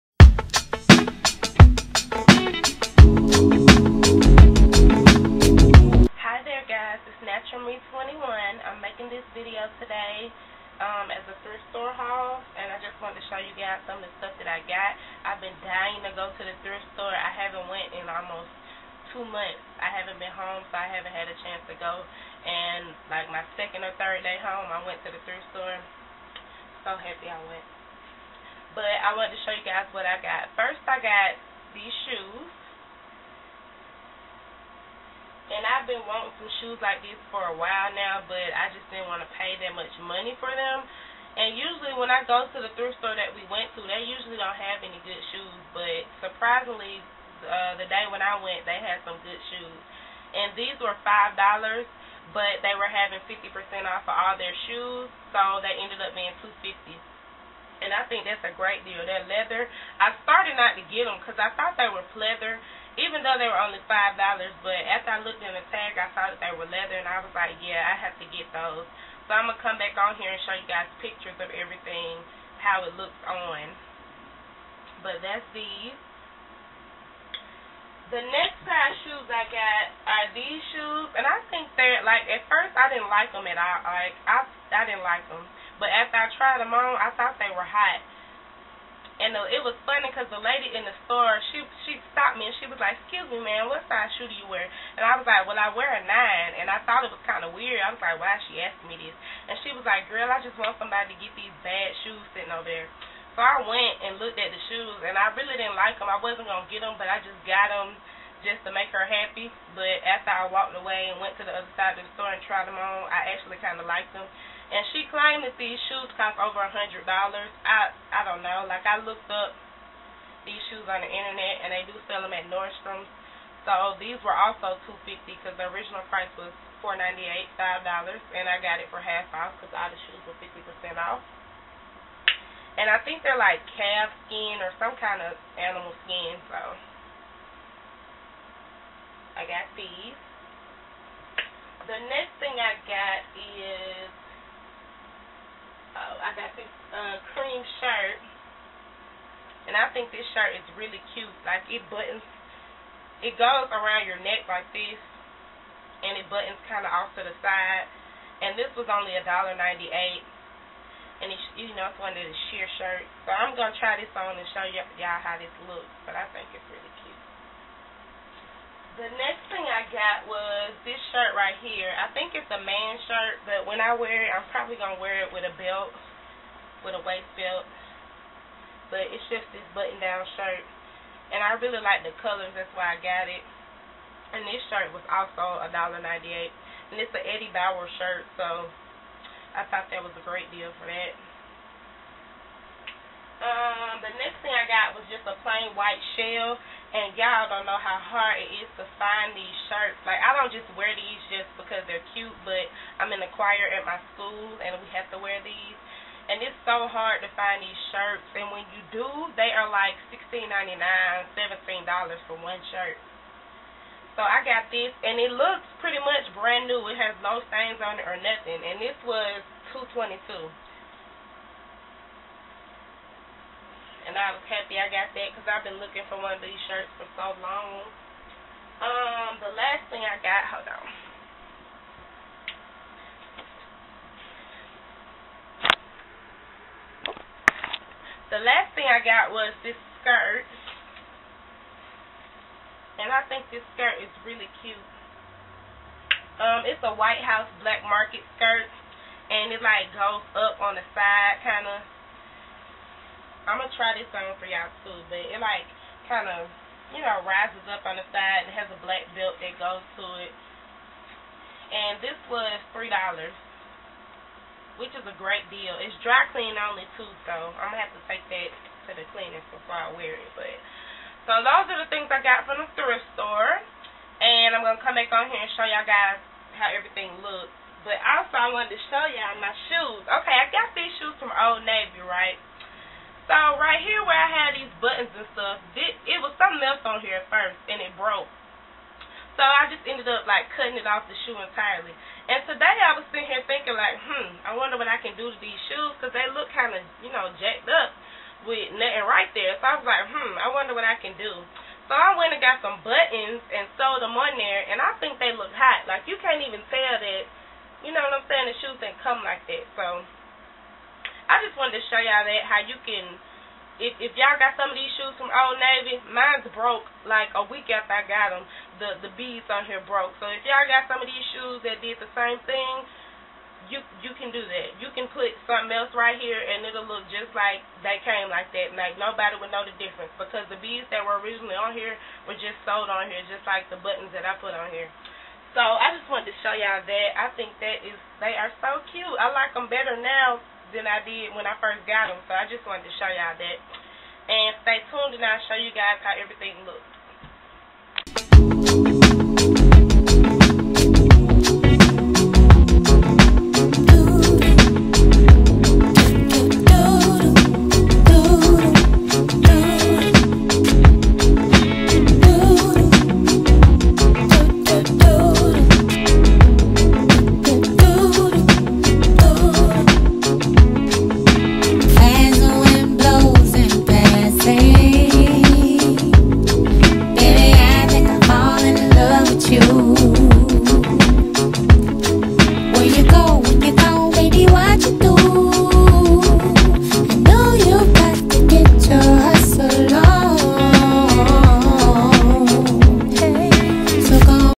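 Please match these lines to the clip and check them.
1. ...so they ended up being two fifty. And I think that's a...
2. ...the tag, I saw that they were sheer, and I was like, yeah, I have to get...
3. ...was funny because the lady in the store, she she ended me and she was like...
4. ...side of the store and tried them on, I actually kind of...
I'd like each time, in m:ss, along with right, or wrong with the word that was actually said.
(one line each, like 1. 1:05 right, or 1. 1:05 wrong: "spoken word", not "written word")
1. 0:55 right
2. 1:05 wrong: "leather", not "sheer"
3. 1:29 wrong: "stopped", not "ended"
4. 1:51 right.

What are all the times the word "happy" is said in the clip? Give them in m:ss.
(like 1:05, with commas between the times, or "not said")
0:26, 1:49, 3:44.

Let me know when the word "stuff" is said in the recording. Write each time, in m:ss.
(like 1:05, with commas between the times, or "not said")
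0:14, 4:45.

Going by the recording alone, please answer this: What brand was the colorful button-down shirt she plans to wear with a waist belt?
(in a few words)
Eddie Bauer.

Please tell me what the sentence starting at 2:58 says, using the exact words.
But it's just this button-down shirt.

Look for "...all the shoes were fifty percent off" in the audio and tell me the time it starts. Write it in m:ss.
2:09.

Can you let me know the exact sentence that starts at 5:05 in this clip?
Like you can't even tell that, you know what I'm saying?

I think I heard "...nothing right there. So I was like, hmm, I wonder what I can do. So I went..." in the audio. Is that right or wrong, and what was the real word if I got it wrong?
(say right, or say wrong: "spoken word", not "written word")
right.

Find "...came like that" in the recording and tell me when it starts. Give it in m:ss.
5:28.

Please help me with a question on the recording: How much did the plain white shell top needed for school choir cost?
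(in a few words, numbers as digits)
$2.22.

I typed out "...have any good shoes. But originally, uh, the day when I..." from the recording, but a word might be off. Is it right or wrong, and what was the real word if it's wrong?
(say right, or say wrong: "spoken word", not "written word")
wrong: "surprisingly", not "originally".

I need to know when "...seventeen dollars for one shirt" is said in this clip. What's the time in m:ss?
3:31.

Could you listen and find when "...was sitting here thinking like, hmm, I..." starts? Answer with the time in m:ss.
4:52.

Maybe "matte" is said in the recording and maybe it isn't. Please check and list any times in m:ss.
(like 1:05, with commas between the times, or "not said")
not said.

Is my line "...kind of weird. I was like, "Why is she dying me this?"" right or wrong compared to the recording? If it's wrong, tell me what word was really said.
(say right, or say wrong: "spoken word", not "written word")
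wrong: "asking", not "dying".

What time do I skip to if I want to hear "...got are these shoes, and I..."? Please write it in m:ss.
1:19.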